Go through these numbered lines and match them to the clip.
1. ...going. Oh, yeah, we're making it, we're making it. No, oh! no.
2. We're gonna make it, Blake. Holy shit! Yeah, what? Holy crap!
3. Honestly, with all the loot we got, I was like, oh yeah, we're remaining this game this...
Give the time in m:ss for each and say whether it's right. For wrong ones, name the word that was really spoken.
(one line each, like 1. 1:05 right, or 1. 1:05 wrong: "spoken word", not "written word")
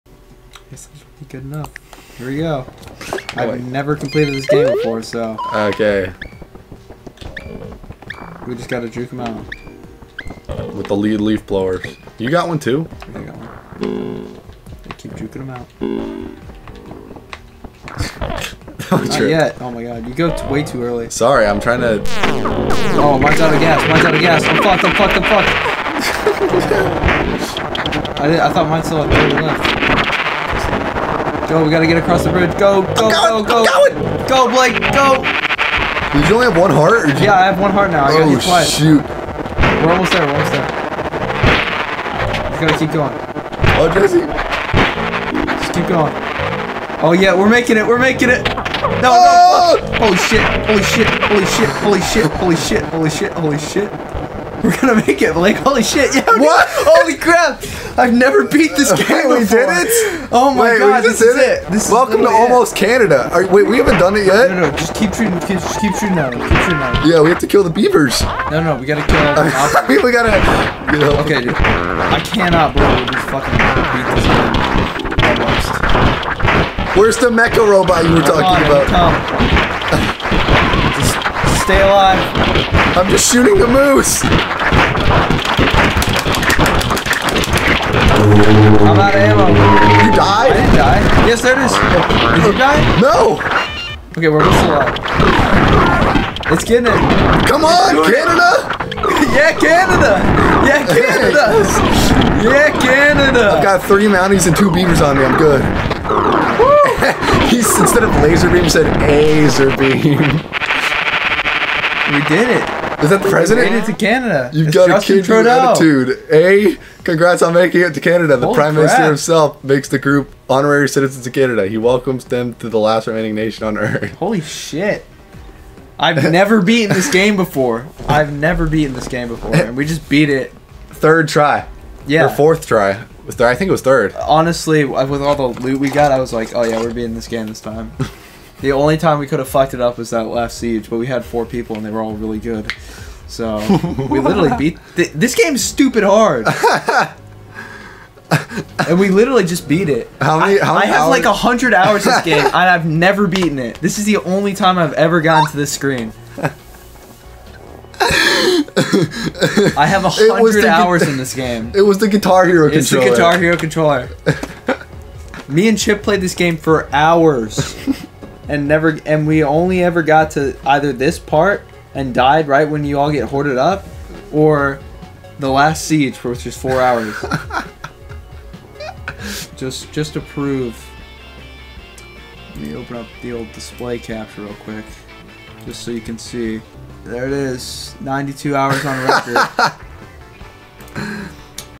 1. 0:45 right
2. 0:54 right
3. 2:14 wrong: "beating", not "remaining".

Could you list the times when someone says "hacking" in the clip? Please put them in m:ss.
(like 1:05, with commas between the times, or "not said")
not said.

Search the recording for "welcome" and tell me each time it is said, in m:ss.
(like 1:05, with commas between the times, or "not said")
1:01, 2:01.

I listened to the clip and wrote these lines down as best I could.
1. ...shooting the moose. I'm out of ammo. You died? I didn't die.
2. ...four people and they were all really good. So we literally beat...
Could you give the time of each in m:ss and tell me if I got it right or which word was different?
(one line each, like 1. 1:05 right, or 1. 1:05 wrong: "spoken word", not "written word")
1. 1:23 right
2. 2:21 right.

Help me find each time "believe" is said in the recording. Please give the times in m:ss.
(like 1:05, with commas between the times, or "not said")
1:12.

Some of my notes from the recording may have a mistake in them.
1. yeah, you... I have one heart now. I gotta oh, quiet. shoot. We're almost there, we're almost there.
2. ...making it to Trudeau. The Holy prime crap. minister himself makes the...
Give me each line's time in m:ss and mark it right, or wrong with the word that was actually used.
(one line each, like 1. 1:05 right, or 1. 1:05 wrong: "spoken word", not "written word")
1. 0:37 right
2. 1:57 wrong: "Canada", not "Trudeau".